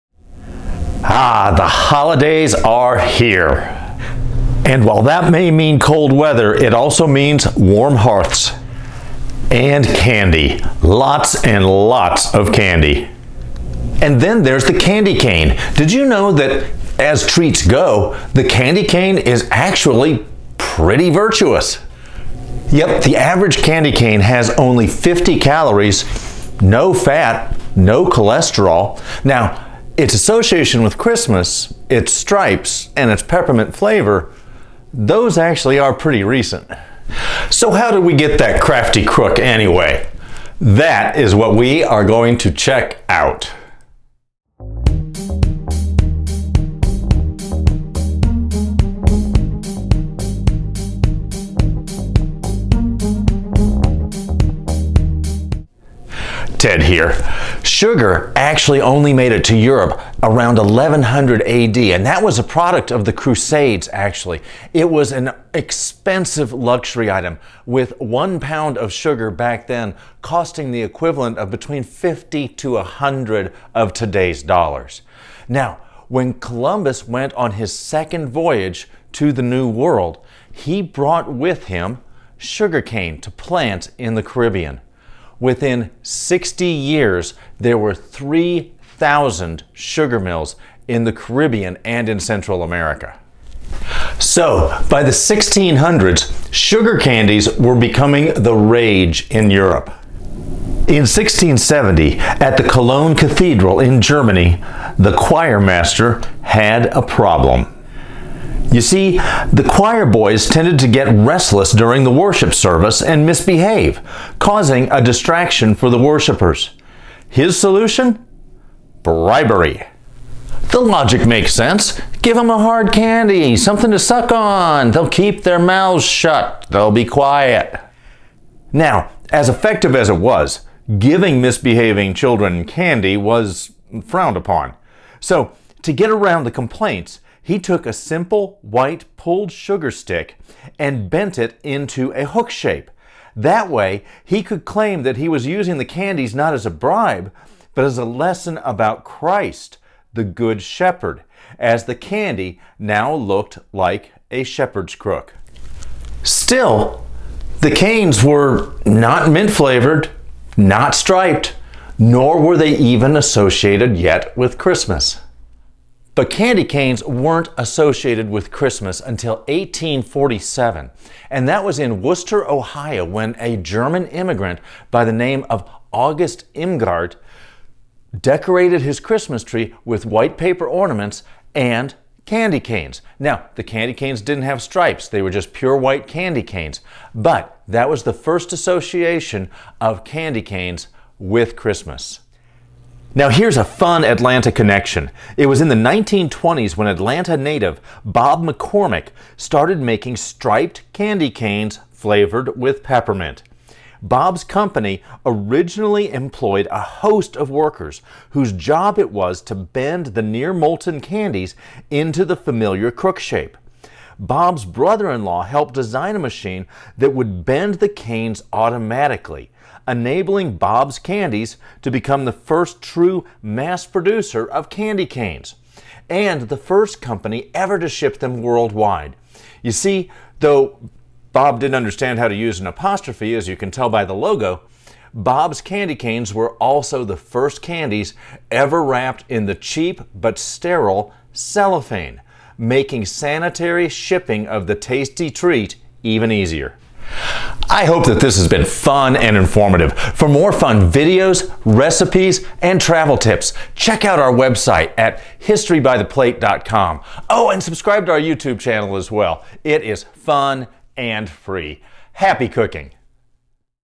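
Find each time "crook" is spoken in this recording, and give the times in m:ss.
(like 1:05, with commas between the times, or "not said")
0:39, 2:34, 3:32.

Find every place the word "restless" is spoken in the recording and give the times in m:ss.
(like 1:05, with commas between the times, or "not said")
1:51.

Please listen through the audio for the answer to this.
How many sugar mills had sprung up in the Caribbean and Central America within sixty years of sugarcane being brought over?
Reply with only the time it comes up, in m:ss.
1:27.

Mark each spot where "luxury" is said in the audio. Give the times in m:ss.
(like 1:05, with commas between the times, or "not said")
1:06.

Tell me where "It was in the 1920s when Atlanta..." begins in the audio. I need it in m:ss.
3:15.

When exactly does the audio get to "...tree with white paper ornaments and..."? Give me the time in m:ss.
2:59.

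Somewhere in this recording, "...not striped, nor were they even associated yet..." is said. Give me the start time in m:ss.
2:40.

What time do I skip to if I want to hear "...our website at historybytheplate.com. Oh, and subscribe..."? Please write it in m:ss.
4:14.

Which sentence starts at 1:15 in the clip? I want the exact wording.
Now, when Columbus went on his second voyage to the New World, he brought with him sugarcane to plant in the Caribbean.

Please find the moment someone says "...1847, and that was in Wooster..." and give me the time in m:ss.
2:49.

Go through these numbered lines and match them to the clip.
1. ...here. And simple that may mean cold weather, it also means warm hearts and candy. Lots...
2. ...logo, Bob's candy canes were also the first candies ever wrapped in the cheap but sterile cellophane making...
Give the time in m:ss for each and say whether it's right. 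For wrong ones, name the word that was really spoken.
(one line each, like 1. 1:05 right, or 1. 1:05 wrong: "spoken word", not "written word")
1. 0:02 wrong: "while", not "simple"
2. 3:54 right.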